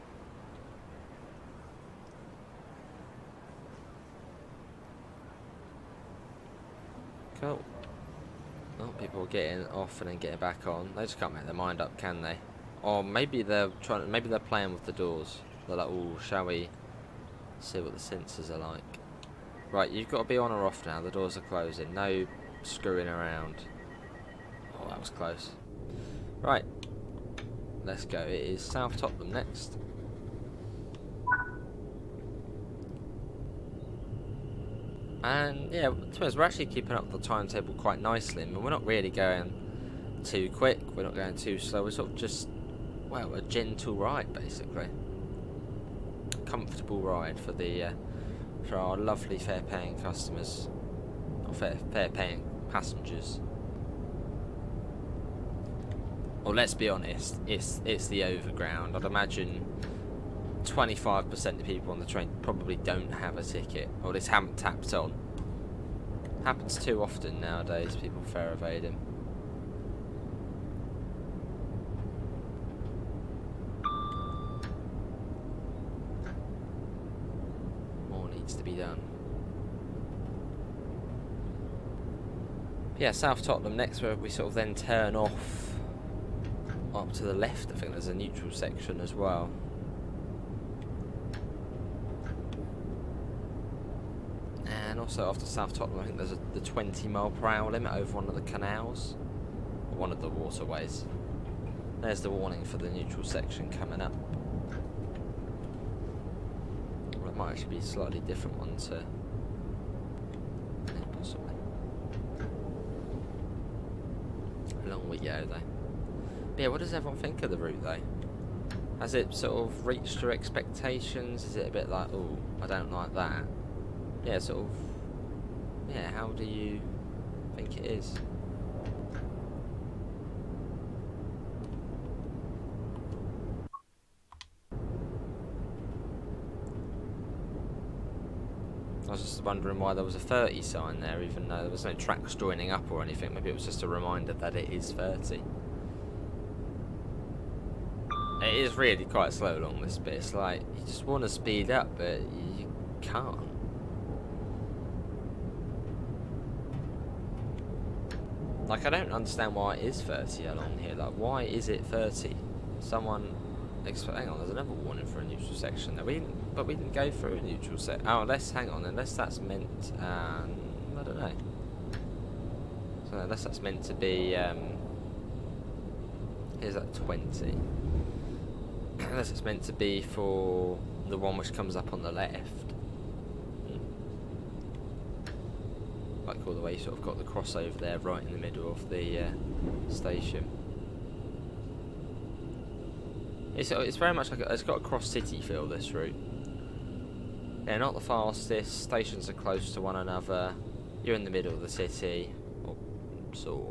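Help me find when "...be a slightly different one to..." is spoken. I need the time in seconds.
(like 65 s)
107 s.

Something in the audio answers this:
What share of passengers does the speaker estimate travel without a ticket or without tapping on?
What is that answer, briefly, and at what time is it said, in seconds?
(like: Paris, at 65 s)
25%, at 60 s.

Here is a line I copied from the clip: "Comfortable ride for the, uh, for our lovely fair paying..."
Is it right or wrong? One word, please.
right.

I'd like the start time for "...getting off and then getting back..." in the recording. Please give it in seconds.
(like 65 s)
9 s.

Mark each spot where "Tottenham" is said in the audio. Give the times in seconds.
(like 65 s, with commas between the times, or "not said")
28 s, 83 s, 95 s.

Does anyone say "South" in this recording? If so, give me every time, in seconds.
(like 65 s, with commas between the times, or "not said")
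28 s, 83 s, 95 s.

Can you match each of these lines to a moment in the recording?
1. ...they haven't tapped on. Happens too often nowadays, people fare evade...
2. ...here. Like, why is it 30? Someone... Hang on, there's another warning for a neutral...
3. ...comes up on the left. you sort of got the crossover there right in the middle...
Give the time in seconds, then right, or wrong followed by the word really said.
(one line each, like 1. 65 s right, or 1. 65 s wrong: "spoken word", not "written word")
1. 64 s right
2. 160 s right
3. 181 s right.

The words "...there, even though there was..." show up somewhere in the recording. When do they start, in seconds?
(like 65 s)
141 s.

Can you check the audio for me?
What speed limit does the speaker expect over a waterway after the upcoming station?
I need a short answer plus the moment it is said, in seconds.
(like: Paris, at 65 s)
20 mph, at 96 s.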